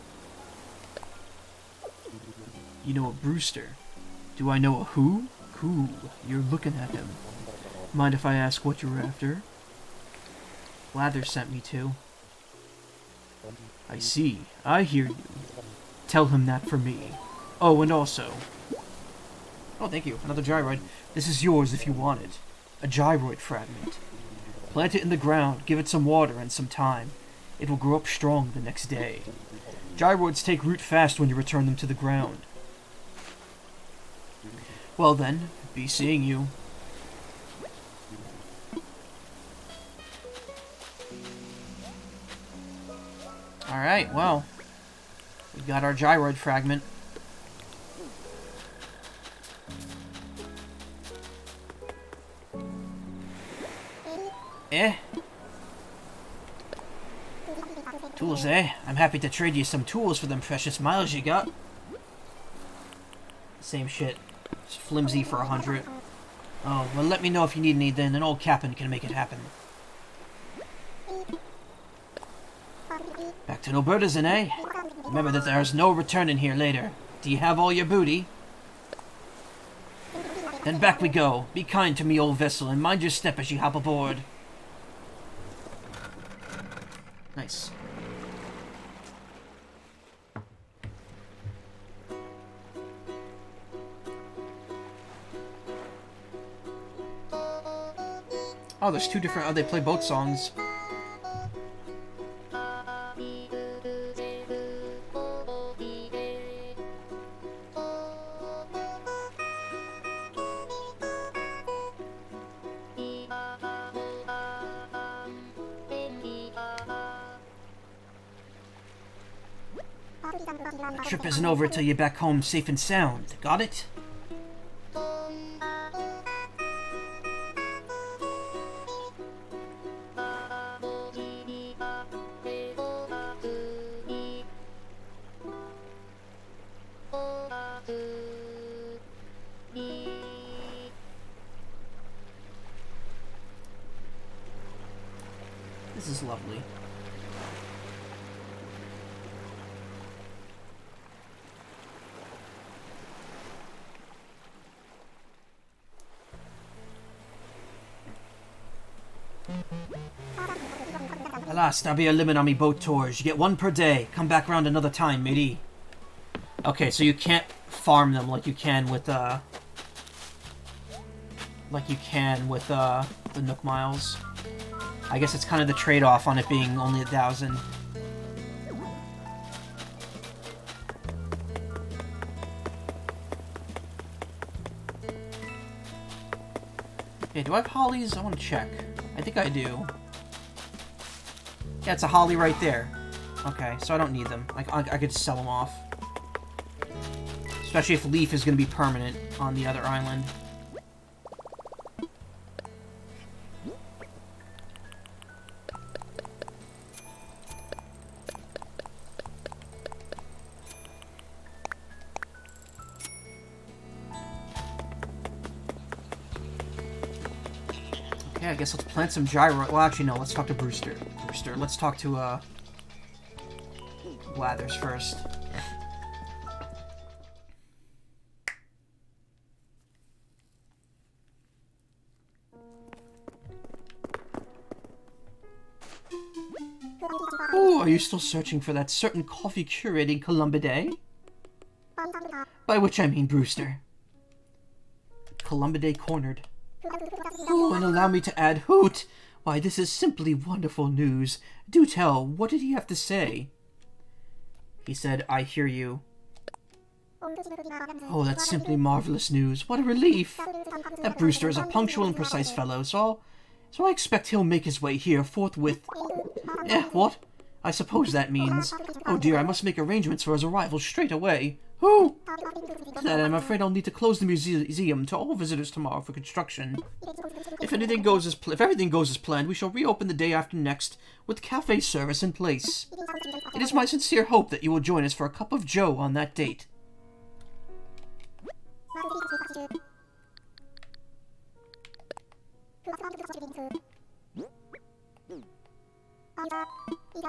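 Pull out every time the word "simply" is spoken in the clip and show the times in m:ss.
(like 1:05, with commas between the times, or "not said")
4:09, 4:18.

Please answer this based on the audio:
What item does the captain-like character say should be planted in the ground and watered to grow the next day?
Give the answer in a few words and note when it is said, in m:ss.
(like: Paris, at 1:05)
A gyroid fragment, at 0:22.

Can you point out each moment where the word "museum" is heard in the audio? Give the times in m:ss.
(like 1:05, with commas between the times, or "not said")
4:34.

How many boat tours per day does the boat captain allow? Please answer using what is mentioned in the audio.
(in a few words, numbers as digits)
1.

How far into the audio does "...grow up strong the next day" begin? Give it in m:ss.
0:27.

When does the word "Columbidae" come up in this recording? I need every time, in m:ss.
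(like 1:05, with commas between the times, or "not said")
4:00, 4:05.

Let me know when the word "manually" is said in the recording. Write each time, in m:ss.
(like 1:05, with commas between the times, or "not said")
not said.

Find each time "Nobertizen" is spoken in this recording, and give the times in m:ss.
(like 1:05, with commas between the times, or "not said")
1:13.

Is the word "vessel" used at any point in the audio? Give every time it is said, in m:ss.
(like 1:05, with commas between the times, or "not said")
1:22.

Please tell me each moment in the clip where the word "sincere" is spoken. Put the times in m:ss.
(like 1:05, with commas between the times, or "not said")
4:43.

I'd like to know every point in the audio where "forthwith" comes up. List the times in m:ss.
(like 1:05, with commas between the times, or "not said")
4:25.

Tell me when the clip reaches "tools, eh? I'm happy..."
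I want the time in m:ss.
0:58.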